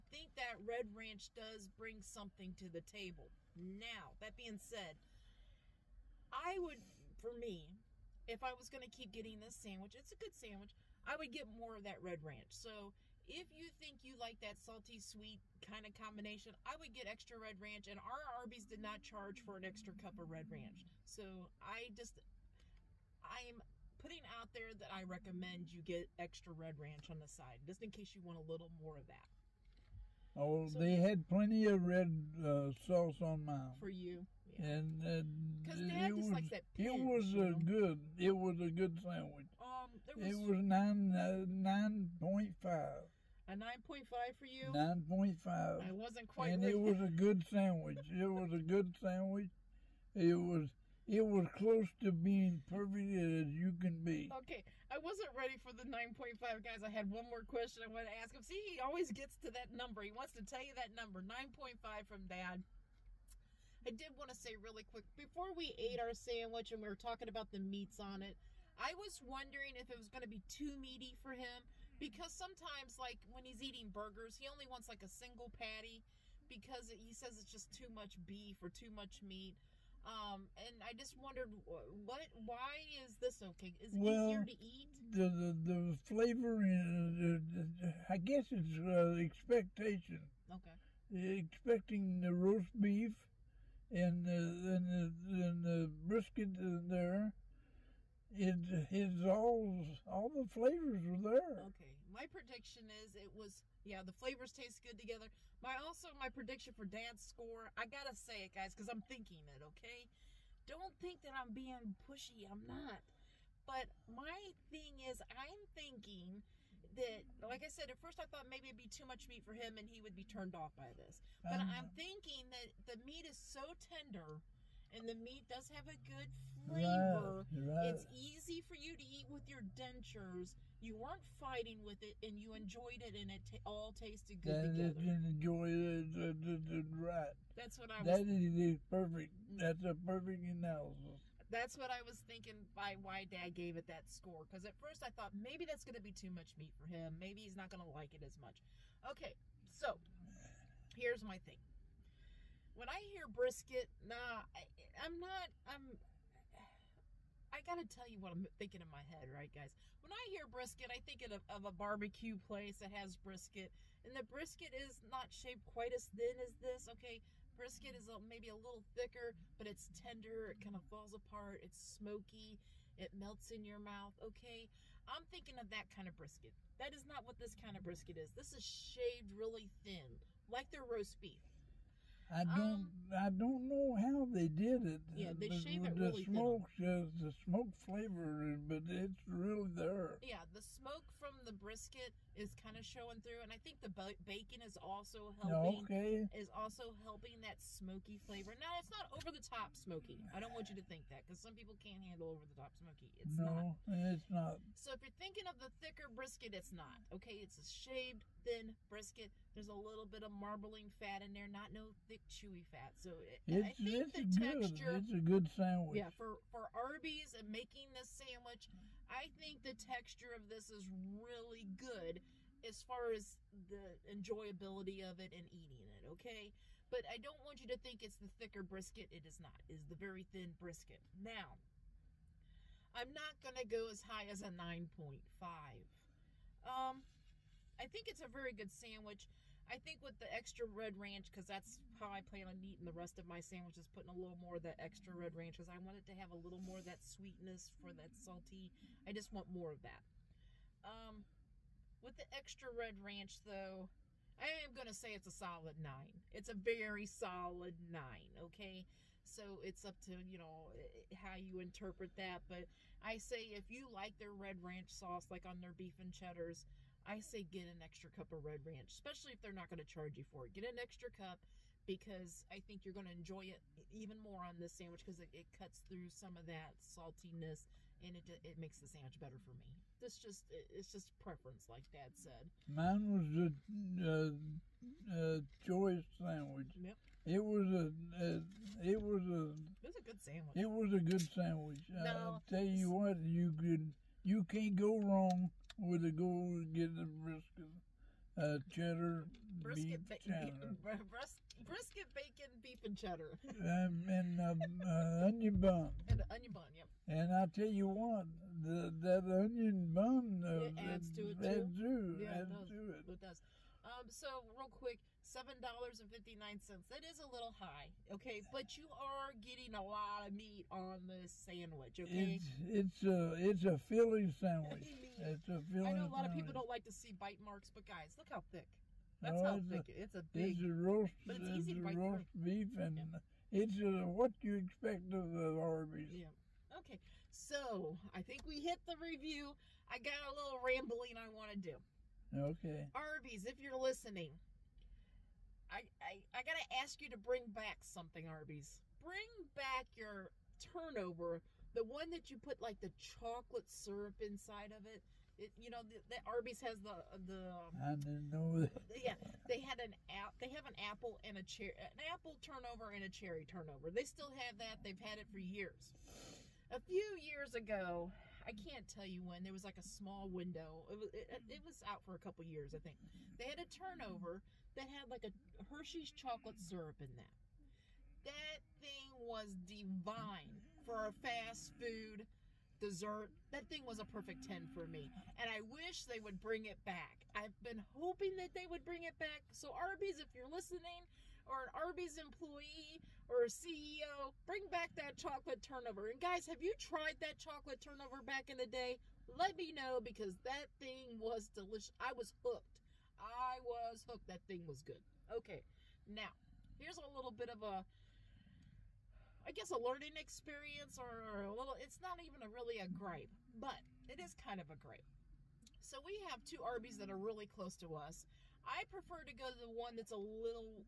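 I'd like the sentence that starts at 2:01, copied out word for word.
But um, I'm thinking that the meat is so tender and the meat does have a good flavor.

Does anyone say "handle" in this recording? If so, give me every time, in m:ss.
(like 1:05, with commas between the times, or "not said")
3:22.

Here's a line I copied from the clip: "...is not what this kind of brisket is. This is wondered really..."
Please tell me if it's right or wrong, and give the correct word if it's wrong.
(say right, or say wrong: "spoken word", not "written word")
wrong: "shaved", not "wondered".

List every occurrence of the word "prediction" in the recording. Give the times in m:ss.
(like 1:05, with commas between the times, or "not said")
1:42, 1:46.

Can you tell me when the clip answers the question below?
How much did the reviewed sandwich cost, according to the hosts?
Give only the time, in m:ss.
5:15.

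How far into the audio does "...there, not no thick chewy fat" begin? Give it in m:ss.
3:31.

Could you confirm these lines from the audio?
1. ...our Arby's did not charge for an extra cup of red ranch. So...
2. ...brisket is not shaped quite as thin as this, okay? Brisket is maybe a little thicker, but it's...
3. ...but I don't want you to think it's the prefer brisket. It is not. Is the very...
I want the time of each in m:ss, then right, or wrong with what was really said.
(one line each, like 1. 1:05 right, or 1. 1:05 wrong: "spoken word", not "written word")
1. 0:17 right
2. 2:44 right
3. 3:46 wrong: "thicker", not "prefer".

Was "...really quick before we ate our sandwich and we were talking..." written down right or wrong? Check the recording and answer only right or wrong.
right.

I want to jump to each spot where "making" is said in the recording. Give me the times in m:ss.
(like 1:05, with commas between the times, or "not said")
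3:37.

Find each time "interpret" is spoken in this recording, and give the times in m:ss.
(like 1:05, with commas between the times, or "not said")
4:21.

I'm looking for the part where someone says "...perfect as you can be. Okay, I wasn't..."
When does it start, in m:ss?
0:52.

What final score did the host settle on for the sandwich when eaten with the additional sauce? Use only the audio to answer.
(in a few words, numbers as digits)
9.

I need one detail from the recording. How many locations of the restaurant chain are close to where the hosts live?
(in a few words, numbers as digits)
2.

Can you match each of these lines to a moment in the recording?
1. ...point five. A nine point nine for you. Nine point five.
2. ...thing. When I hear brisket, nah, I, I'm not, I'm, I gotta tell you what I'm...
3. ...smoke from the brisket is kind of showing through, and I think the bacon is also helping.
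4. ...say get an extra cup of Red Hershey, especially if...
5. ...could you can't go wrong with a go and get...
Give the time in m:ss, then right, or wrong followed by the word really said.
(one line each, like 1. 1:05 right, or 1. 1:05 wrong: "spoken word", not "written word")
1. 0:42 wrong: "five", not "nine"
2. 2:31 right
3. 3:10 right
4. 4:27 wrong: "Ranch", not "Hershey"
5. 4:53 right.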